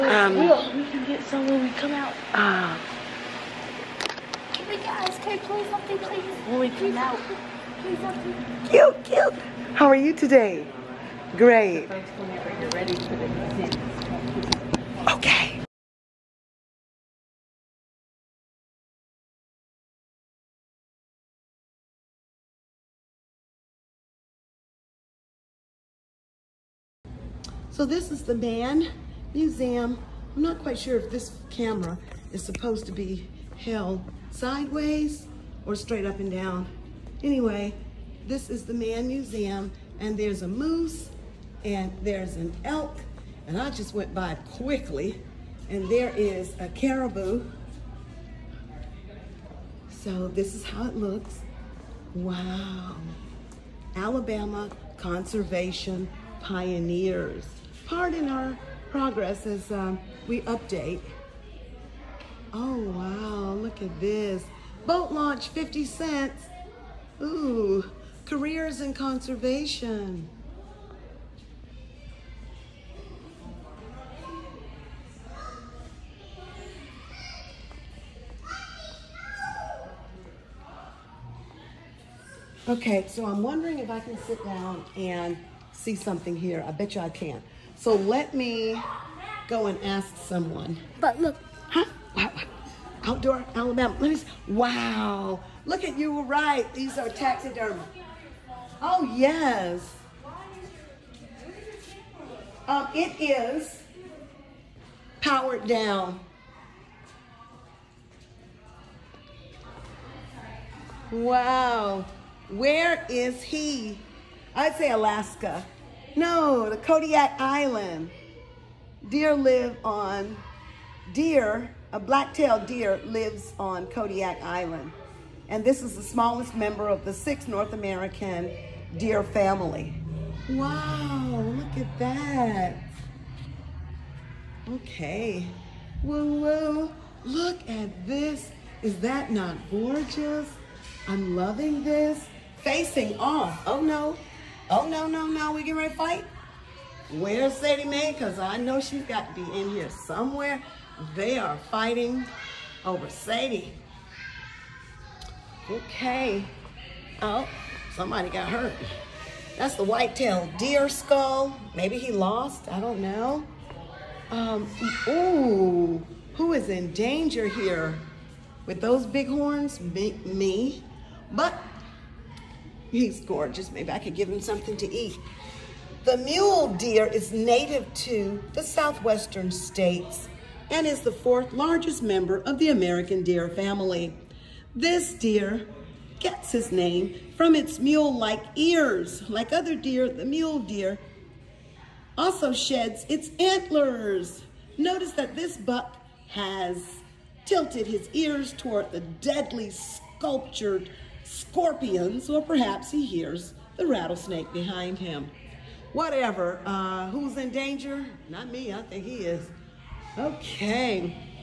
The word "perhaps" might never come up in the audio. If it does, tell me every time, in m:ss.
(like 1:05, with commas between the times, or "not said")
3:22.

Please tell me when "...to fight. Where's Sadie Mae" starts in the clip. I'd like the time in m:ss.
2:25.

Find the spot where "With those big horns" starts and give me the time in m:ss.
2:48.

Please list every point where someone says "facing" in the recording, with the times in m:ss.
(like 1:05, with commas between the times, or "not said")
2:22.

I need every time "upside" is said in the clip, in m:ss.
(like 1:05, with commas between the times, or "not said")
not said.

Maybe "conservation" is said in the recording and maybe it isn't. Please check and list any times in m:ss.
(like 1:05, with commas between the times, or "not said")
0:54, 1:08.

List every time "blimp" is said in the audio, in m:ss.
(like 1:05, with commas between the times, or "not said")
not said.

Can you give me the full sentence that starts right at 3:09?
Like other deer, the mule deer also sheds its antlers.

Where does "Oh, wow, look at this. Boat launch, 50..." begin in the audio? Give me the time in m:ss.
1:02.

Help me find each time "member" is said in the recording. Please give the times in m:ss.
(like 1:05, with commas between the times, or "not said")
2:06, 3:02.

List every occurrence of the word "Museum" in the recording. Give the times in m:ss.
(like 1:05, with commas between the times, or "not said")
0:29, 0:39.